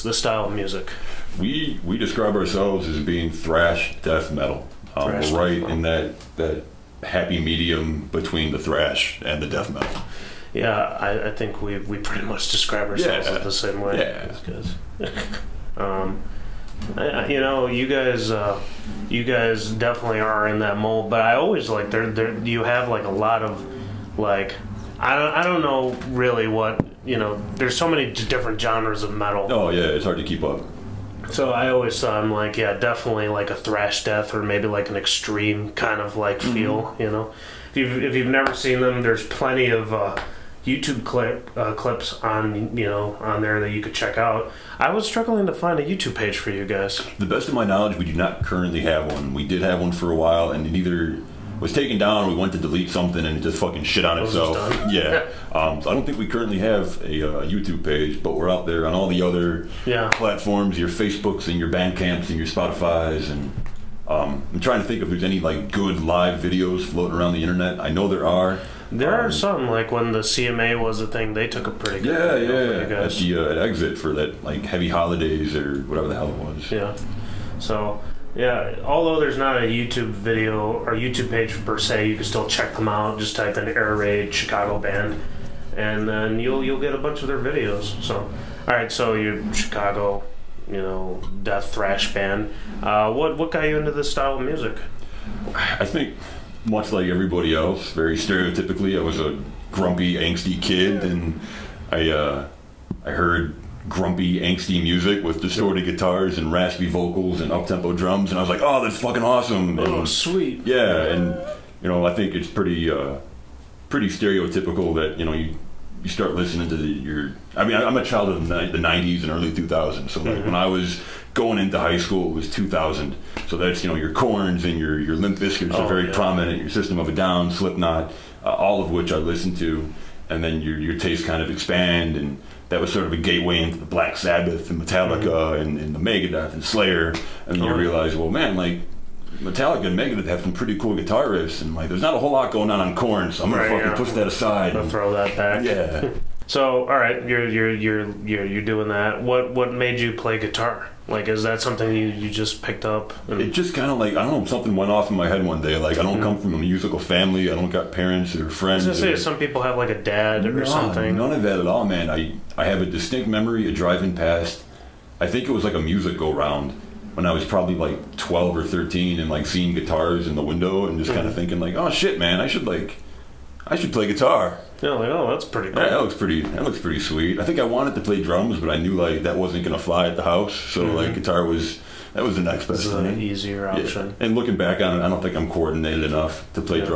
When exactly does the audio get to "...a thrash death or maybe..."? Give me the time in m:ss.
0:33.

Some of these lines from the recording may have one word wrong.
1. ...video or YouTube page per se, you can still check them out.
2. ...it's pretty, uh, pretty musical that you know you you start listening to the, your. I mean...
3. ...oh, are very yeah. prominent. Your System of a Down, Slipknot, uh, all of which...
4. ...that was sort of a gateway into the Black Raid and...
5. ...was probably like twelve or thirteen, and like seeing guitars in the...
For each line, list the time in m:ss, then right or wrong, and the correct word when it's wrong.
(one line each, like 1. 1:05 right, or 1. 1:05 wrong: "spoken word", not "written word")
1. 1:20 right
2. 1:52 wrong: "stereotypical", not "musical"
3. 2:05 right
4. 2:12 wrong: "Sabbath", not "Raid"
5. 2:47 right.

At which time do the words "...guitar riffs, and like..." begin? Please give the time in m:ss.
2:20.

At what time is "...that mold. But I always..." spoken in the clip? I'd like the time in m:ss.
0:20.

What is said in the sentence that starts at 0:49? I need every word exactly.
We did have one for a while, and it either was taken down.